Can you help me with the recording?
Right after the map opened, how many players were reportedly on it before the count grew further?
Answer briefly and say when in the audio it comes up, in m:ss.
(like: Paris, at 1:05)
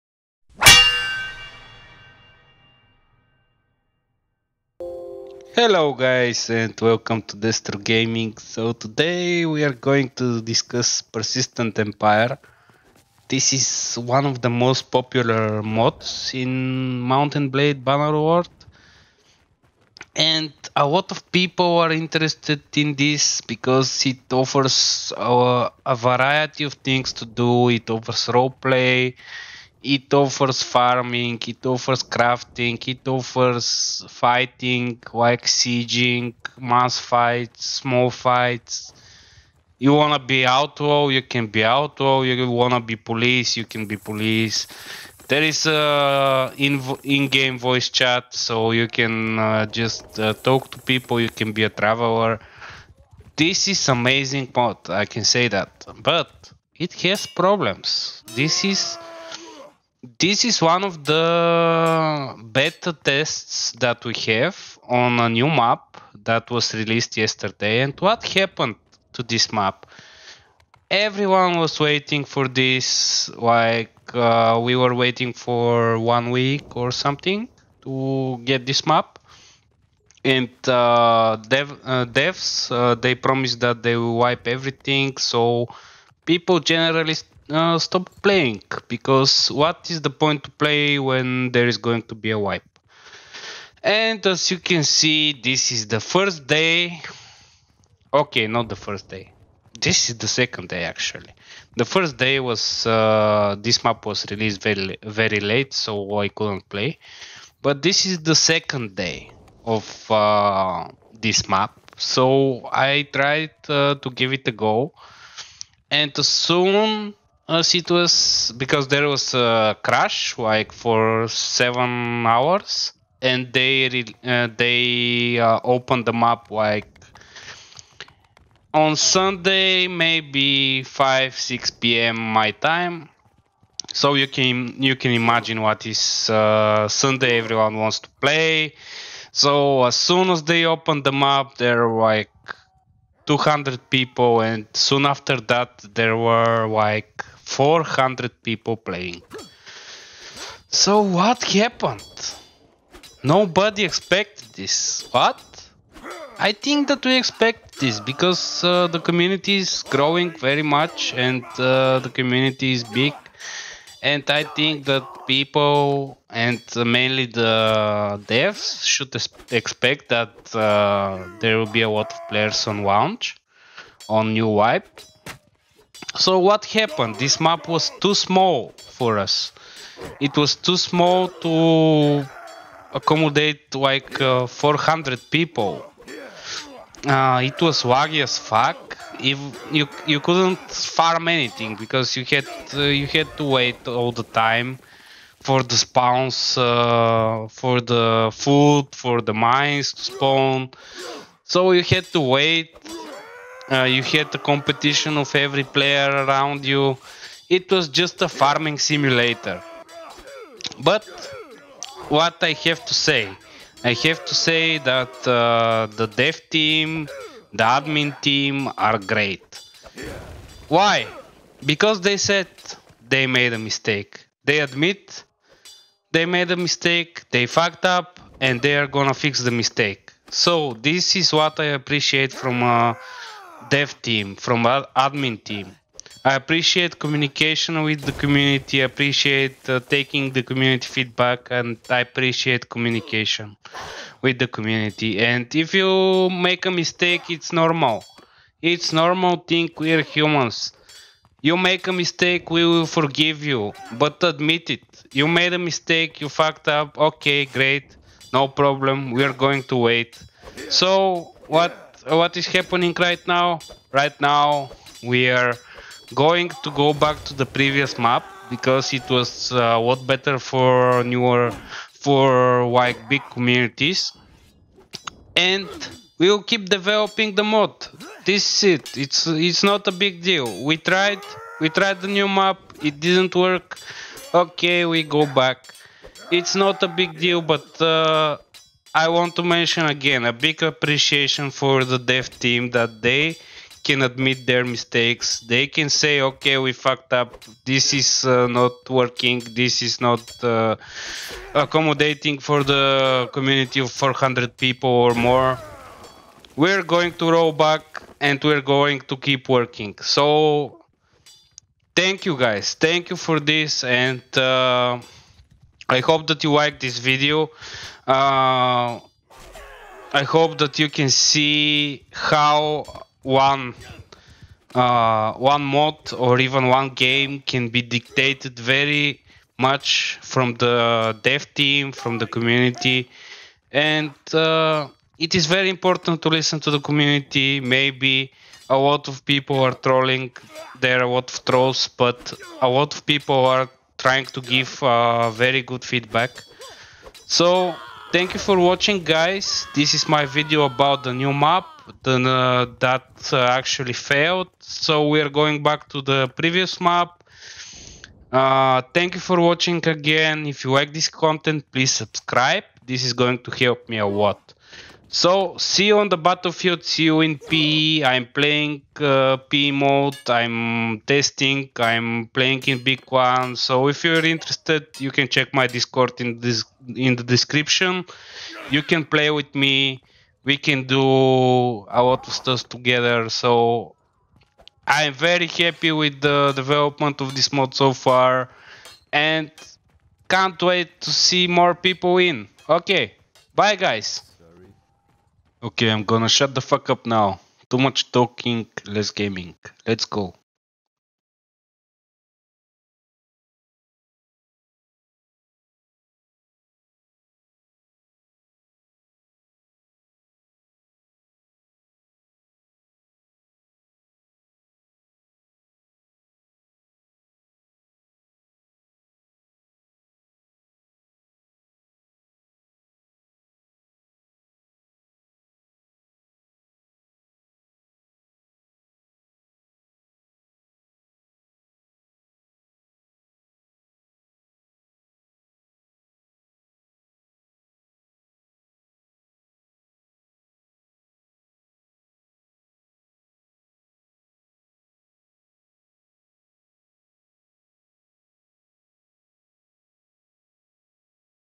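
200, at 2:23.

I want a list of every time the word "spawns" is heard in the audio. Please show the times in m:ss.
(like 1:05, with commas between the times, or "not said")
3:15, 3:20.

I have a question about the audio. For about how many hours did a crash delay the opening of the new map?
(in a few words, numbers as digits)
7 hours.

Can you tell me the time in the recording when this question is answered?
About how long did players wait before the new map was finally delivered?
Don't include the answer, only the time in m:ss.
1:15.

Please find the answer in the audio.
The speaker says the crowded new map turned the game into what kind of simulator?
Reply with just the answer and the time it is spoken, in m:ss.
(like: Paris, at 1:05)
farming simulator, at 3:28.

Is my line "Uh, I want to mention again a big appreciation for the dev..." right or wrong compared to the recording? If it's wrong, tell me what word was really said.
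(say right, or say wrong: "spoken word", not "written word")
right.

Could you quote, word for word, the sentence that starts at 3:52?
Uh, dev team, from ad- admin team.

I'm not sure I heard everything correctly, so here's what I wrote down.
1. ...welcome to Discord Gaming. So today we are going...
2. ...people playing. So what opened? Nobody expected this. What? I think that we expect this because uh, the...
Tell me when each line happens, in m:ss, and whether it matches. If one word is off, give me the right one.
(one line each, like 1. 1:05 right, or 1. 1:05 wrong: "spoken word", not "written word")
1. 0:06 wrong: "Destro", not "Discord"
2. 2:28 wrong: "happened", not "opened".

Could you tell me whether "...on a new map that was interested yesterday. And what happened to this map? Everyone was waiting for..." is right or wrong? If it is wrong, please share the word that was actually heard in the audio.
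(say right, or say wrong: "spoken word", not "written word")
wrong: "released", not "interested".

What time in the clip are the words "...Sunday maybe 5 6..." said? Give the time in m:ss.
2:08.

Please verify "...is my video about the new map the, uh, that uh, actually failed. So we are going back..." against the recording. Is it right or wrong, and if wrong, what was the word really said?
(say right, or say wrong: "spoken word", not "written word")
right.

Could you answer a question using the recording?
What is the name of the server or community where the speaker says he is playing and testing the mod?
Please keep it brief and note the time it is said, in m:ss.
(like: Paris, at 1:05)
Big One, at 6:12.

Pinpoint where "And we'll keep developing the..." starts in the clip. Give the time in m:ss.
4:35.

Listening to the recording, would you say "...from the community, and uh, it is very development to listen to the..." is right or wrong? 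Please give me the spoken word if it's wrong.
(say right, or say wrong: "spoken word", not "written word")
wrong: "important", not "development".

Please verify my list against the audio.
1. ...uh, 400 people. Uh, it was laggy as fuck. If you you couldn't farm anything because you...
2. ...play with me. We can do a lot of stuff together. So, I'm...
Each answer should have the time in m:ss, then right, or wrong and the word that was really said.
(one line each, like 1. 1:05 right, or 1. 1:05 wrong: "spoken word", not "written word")
1. 3:04 right
2. 6:19 right.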